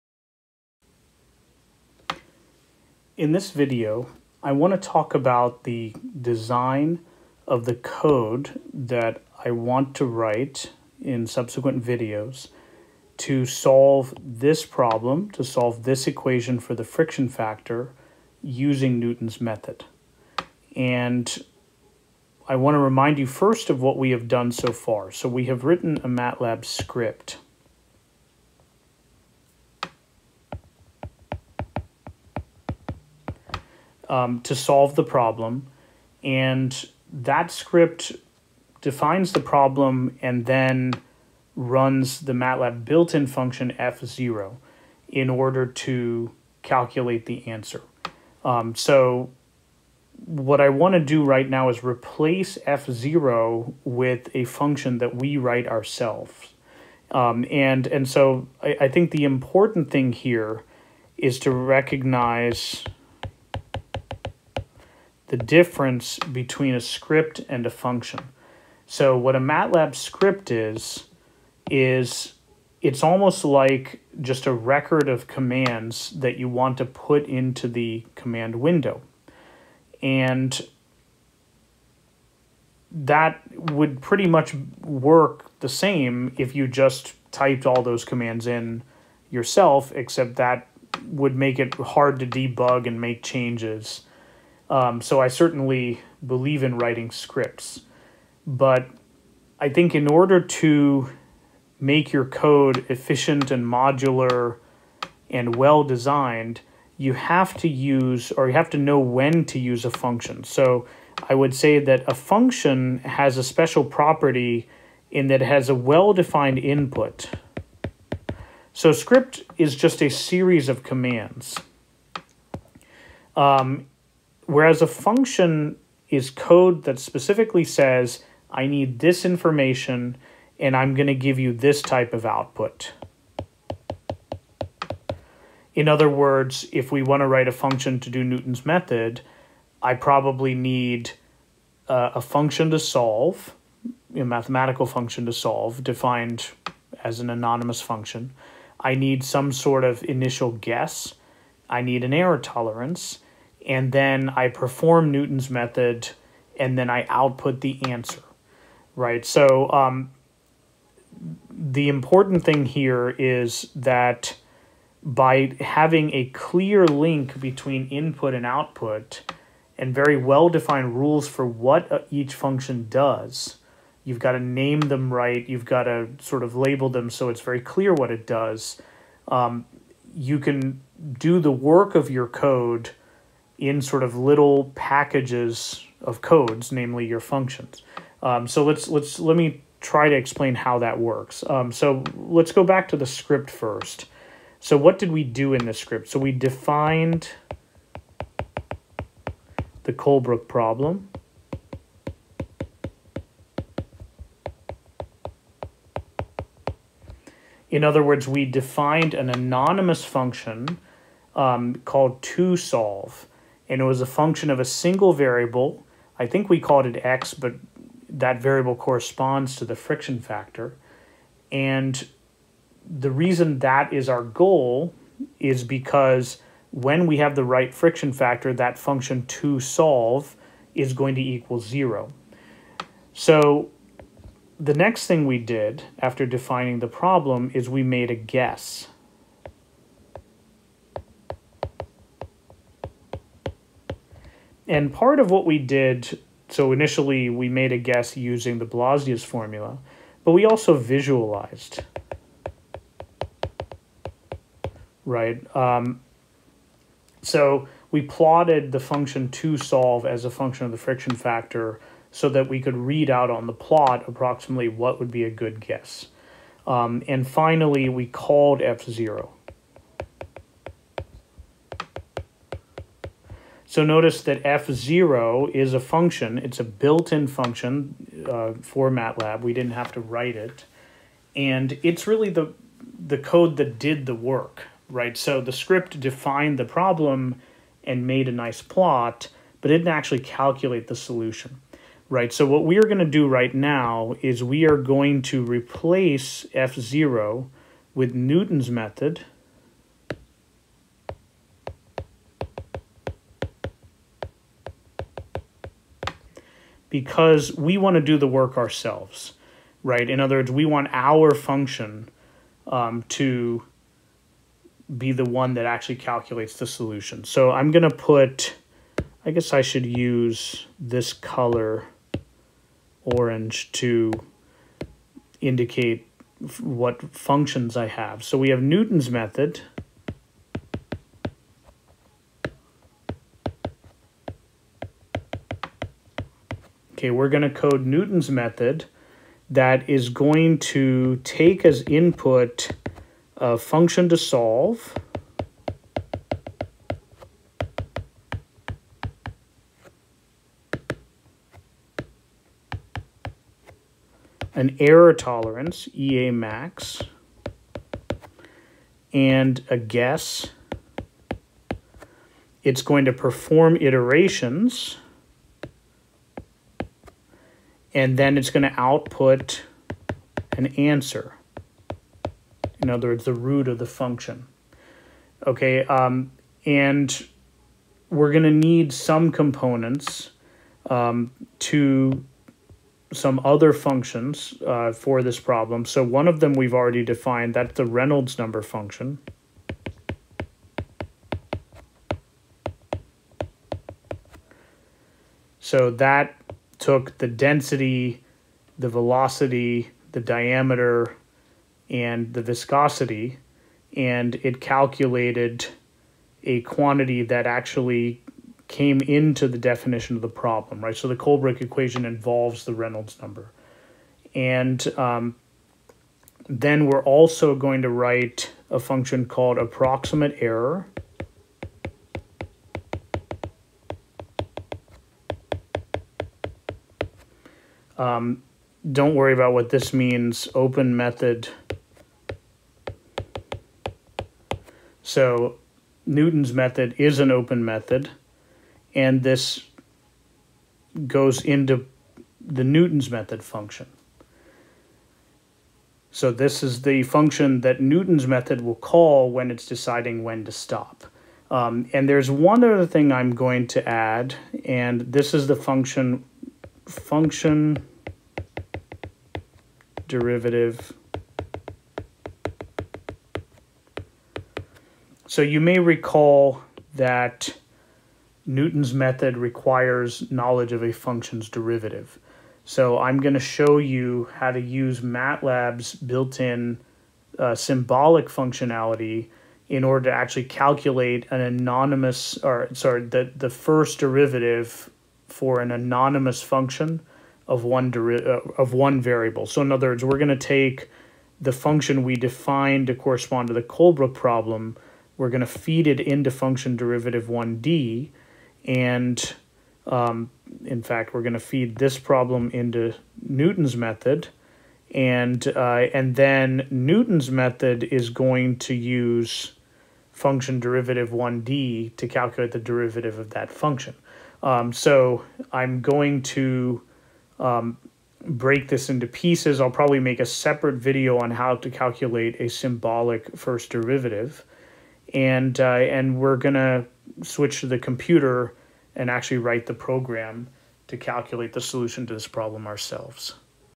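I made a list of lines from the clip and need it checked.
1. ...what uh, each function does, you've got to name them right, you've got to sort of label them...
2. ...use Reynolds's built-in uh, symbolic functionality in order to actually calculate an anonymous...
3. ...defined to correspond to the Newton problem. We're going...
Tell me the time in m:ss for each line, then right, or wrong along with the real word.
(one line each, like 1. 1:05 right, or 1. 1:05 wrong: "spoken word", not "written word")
1. 2:51 right
2. 7:54 wrong: "MATLAB", not "Reynolds"
3. 8:12 wrong: "Colebrook", not "Newton".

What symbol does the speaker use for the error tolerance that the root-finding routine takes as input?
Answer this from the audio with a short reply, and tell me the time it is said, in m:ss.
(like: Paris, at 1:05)
EA max, at 5:55.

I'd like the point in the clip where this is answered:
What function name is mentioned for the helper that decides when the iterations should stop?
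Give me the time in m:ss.
6:59.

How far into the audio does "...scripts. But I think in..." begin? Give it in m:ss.
1:37.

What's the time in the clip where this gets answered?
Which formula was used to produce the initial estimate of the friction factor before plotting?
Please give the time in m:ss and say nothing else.
4:08.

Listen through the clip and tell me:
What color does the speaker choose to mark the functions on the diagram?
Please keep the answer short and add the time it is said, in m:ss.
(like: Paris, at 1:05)
orange, at 5:23.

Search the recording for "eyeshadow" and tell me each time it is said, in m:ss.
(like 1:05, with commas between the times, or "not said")
not said.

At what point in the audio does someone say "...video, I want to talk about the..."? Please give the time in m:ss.
0:03.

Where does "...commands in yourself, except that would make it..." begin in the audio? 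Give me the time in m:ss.
1:28.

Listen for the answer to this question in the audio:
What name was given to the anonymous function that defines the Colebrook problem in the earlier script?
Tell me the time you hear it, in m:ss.
3:32.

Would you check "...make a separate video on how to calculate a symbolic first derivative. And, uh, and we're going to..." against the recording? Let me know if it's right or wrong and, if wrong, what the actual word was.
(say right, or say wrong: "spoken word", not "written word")
right.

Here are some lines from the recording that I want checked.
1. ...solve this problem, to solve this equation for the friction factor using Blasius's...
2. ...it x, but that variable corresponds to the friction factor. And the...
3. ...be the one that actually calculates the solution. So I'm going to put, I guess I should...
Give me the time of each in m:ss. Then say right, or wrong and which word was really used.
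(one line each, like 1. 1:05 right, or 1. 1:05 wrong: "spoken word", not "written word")
1. 0:13 wrong: "Newton", not "Blasius"
2. 3:36 right
3. 5:14 right.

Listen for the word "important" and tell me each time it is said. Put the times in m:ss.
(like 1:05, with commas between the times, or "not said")
0:59, 2:41.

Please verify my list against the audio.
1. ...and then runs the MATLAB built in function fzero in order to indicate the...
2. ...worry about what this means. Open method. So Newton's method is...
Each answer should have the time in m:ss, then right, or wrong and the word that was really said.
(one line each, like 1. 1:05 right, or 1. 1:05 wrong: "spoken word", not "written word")
1. 0:40 wrong: "calculate", not "indicate"
2. 7:09 right.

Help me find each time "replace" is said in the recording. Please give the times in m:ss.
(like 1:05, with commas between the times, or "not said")
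0:51, 4:55.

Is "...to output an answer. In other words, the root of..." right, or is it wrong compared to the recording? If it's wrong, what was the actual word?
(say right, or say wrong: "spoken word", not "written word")
right.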